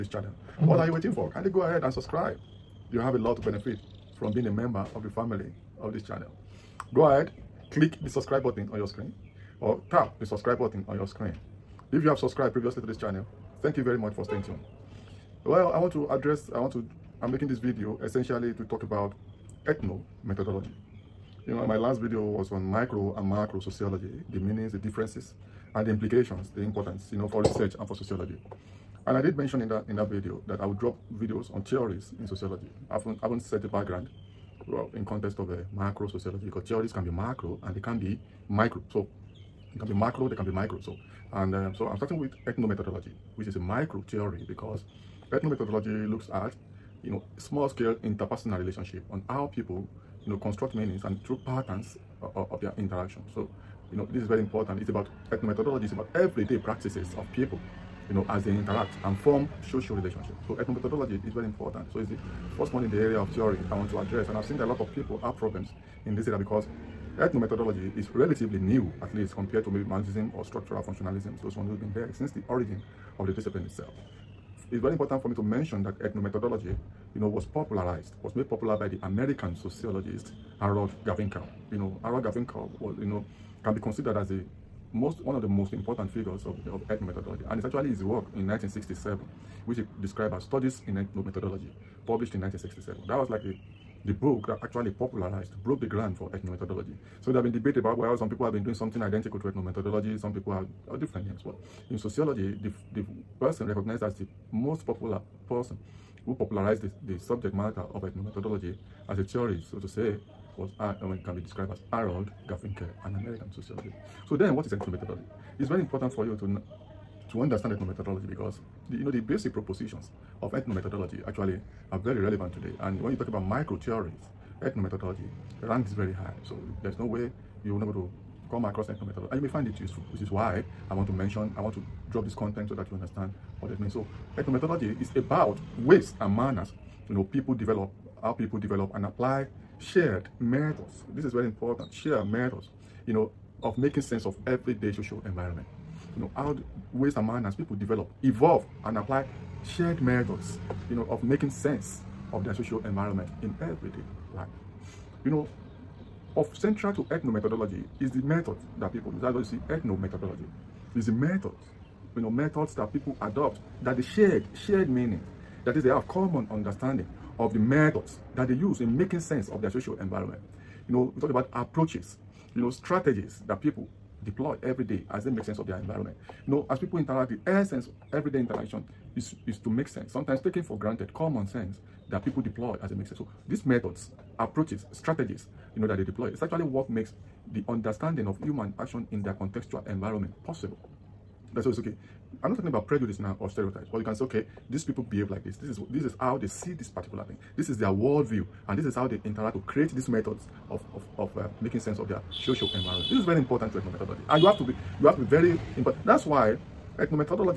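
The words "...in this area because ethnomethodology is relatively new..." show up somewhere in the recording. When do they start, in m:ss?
1:06.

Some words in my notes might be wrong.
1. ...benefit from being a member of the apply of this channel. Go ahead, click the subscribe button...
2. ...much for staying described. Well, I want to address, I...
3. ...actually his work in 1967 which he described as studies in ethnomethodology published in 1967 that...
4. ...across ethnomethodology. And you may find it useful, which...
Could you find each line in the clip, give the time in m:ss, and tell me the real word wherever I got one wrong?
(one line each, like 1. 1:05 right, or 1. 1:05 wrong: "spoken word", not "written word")
1. 0:03 wrong: "family", not "apply"
2. 0:13 wrong: "tuned", not "described"
3. 1:27 right
4. 2:08 right.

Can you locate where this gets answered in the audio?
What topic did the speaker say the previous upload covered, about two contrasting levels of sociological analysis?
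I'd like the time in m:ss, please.
0:22.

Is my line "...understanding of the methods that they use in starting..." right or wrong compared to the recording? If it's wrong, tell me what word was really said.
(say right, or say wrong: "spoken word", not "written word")
wrong: "making", not "starting".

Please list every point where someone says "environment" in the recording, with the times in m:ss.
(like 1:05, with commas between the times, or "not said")
2:25, 2:32, 2:49, 2:55, 3:09, 3:22.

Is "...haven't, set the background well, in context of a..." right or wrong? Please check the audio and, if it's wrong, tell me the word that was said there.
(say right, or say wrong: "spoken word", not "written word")
right.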